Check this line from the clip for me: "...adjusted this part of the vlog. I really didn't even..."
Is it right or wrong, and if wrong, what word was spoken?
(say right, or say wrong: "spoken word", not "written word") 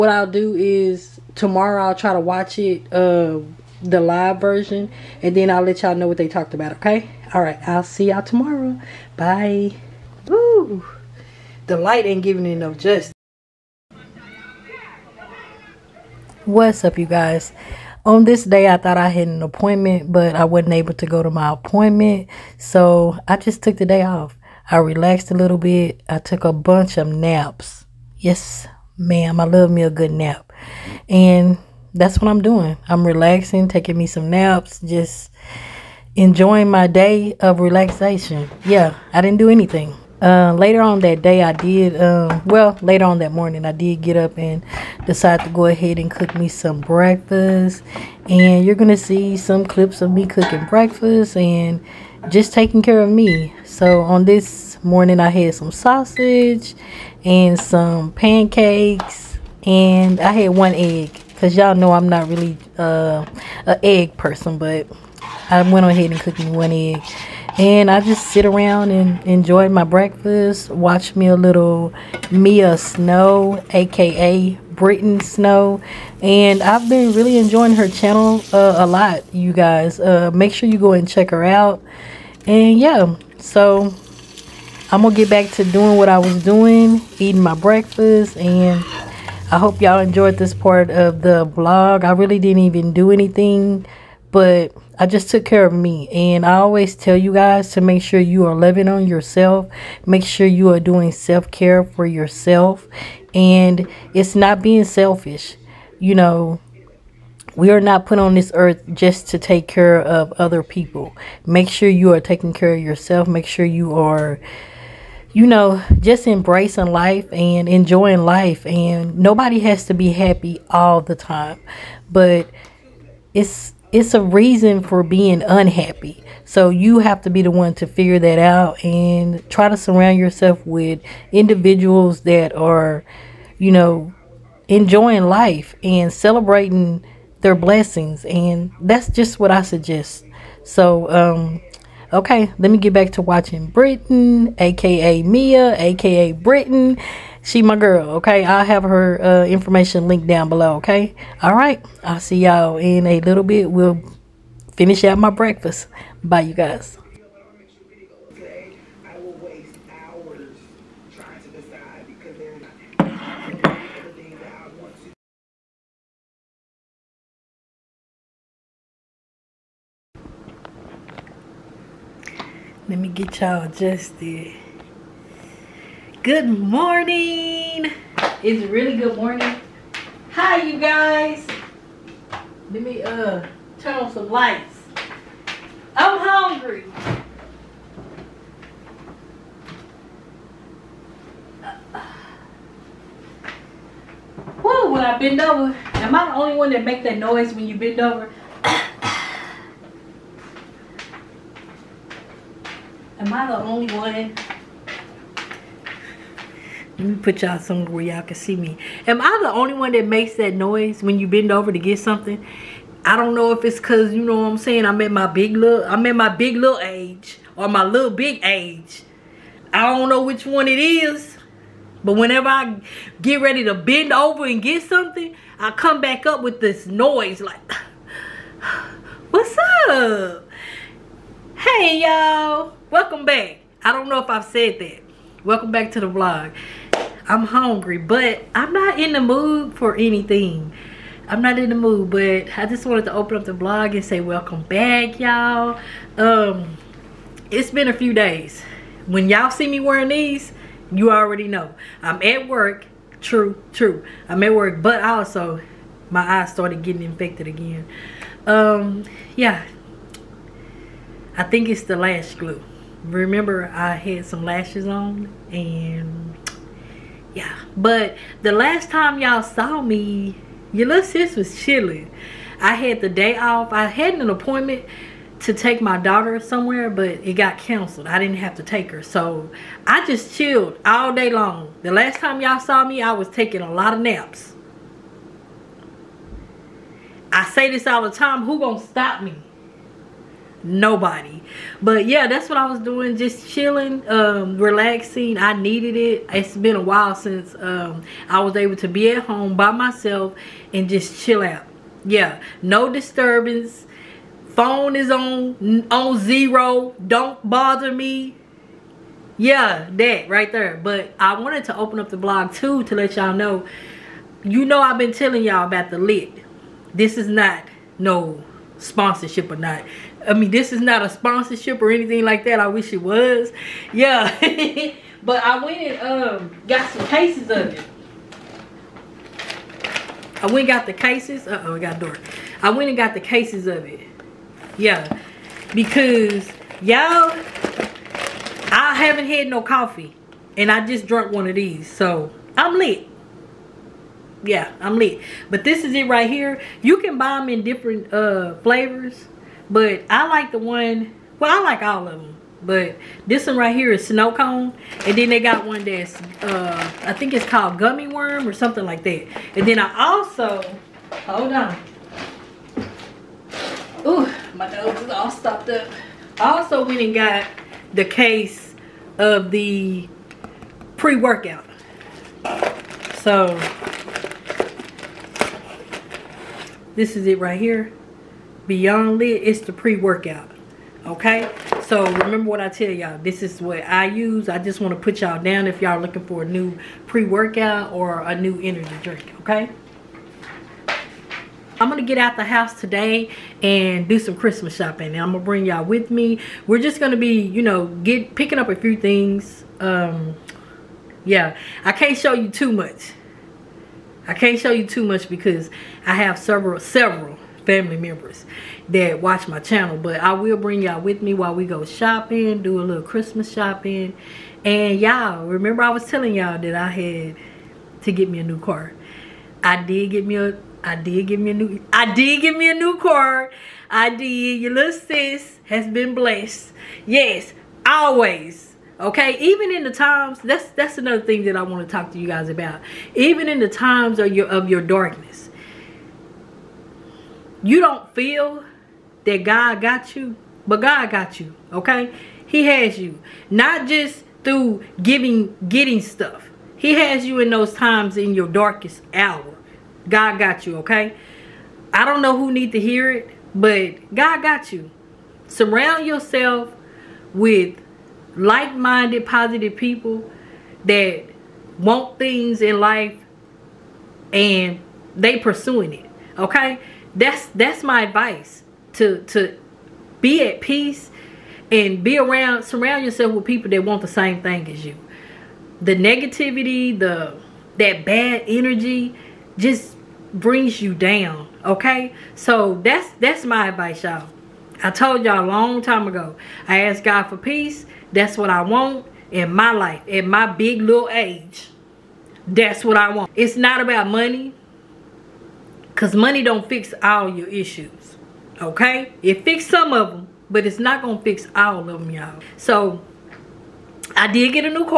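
wrong: "enjoyed", not "adjusted".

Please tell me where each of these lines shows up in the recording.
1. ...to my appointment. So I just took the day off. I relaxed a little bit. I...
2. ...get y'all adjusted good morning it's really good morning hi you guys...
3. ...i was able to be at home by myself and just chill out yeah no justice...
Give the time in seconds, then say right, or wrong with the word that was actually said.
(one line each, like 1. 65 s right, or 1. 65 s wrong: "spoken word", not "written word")
1. 21 s right
2. 173 s right
3. 298 s wrong: "disturbance", not "justice".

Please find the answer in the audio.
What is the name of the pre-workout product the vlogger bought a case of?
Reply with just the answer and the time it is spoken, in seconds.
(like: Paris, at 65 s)
Beyond Lit, at 378 s.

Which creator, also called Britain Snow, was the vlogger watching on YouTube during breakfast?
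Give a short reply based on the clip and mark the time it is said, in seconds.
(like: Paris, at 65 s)
Mia Snow, at 72 s.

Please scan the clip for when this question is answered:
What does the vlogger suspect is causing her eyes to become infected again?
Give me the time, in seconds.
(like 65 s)
261 s.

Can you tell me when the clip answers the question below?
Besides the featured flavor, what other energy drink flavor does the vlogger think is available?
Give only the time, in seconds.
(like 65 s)
357 s.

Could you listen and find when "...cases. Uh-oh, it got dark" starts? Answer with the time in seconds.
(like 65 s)
330 s.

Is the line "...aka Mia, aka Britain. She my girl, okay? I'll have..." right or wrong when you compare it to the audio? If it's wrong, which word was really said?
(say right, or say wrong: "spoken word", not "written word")
right.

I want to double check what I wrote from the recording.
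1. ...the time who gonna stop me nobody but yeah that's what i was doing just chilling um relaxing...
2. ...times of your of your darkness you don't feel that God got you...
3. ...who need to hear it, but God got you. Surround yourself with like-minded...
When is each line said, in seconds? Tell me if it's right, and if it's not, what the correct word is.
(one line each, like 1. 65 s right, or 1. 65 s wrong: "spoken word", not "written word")
1. 288 s right
2. 433 s right
3. 452 s right.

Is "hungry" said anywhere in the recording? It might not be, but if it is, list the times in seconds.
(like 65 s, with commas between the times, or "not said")
186 s, 237 s.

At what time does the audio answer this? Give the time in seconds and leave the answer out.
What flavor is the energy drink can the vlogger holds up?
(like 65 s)
354 s.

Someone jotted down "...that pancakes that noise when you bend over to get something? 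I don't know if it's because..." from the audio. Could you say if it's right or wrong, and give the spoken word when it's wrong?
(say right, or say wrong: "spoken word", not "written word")
wrong: "makes", not "pancakes".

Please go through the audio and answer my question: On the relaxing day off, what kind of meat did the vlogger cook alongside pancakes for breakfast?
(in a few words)
Sausage.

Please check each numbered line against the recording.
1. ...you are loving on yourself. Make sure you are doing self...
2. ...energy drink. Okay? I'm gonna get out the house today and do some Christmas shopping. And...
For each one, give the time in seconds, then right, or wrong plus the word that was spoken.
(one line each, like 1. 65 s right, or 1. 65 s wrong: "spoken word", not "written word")
1. 98 s right
2. 388 s right.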